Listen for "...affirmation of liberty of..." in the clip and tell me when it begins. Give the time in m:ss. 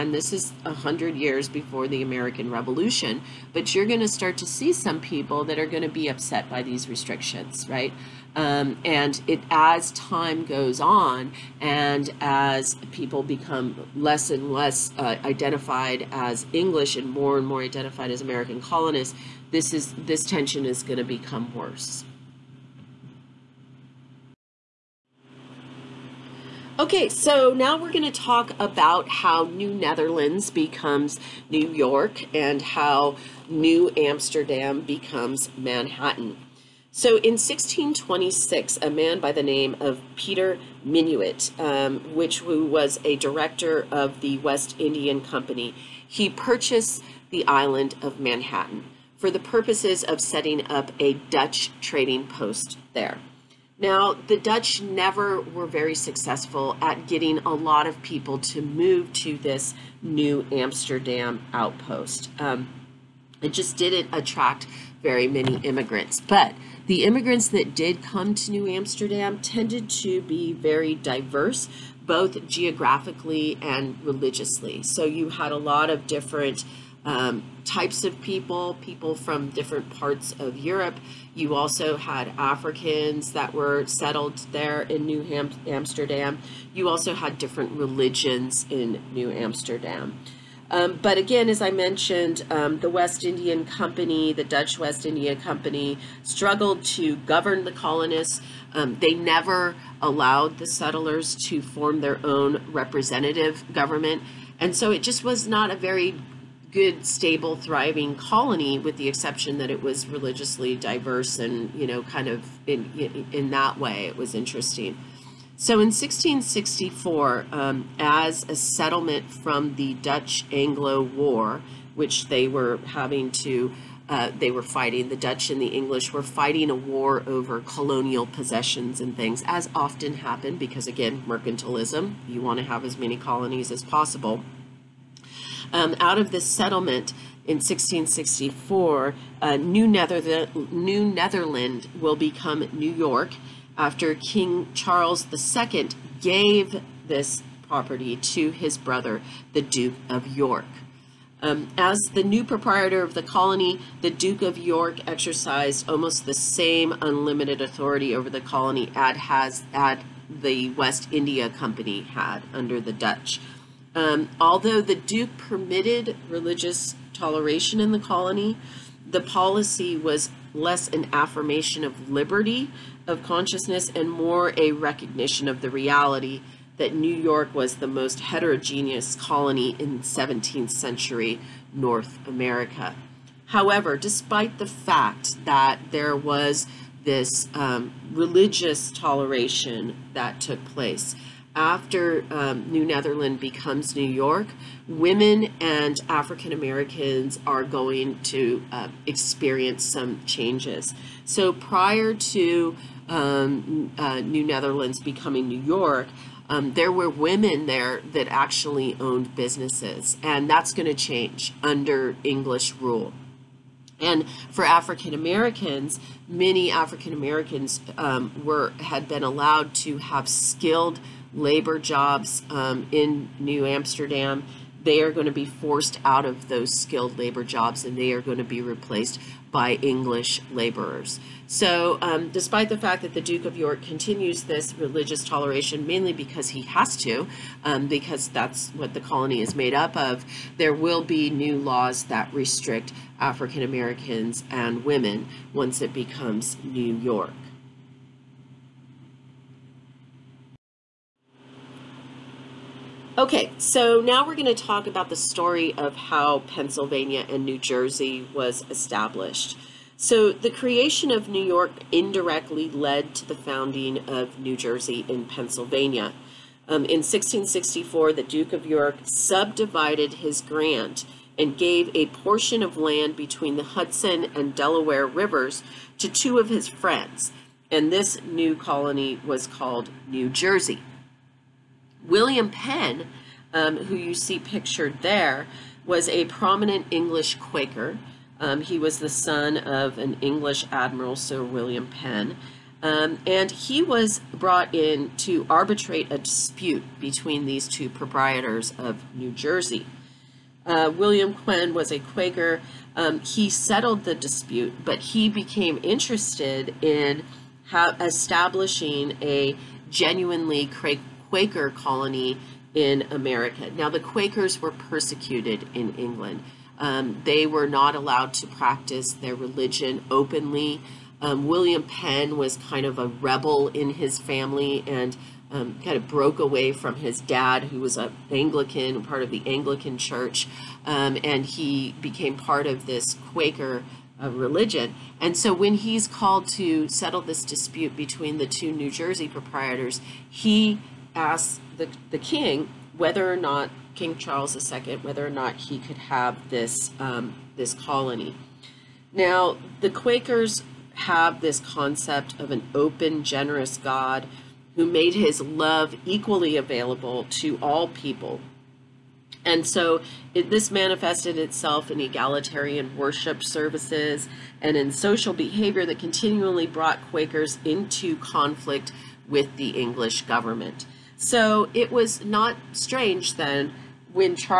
2:51.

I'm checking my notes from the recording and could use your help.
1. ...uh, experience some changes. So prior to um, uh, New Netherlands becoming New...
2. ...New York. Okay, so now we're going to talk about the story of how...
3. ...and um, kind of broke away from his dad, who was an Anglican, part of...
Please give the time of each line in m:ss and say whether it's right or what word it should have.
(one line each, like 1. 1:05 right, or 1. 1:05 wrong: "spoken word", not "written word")
1. 3:18 right
2. 4:06 right
3. 5:24 right.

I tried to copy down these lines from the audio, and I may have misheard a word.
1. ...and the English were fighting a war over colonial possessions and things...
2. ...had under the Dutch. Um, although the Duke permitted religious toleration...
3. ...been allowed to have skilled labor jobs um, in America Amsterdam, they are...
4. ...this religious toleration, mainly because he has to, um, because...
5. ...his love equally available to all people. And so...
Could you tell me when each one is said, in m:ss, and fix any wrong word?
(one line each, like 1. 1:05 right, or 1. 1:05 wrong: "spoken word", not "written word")
1. 2:05 right
2. 2:42 right
3. 3:39 wrong: "New", not "America"
4. 3:54 right
5. 5:55 right.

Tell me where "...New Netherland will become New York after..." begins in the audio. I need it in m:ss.
2:20.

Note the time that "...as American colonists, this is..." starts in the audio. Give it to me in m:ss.
0:18.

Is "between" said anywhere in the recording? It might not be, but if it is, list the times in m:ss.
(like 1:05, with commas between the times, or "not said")
4:33, 4:56, 5:37.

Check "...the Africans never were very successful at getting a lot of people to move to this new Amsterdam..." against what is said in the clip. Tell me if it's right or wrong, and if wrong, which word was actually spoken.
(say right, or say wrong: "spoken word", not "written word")
wrong: "Dutch", not "Africans".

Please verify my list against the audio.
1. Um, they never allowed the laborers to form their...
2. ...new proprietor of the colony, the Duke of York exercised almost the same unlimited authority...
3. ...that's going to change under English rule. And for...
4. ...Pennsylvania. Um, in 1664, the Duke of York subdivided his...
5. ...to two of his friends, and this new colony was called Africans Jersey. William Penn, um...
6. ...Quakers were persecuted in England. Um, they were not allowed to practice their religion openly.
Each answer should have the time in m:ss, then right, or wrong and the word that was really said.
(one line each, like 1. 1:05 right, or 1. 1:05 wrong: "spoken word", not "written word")
1. 1:38 wrong: "settlers", not "laborers"
2. 2:32 right
3. 3:30 right
4. 4:25 right
5. 4:35 wrong: "New", not "Africans"
6. 5:13 right.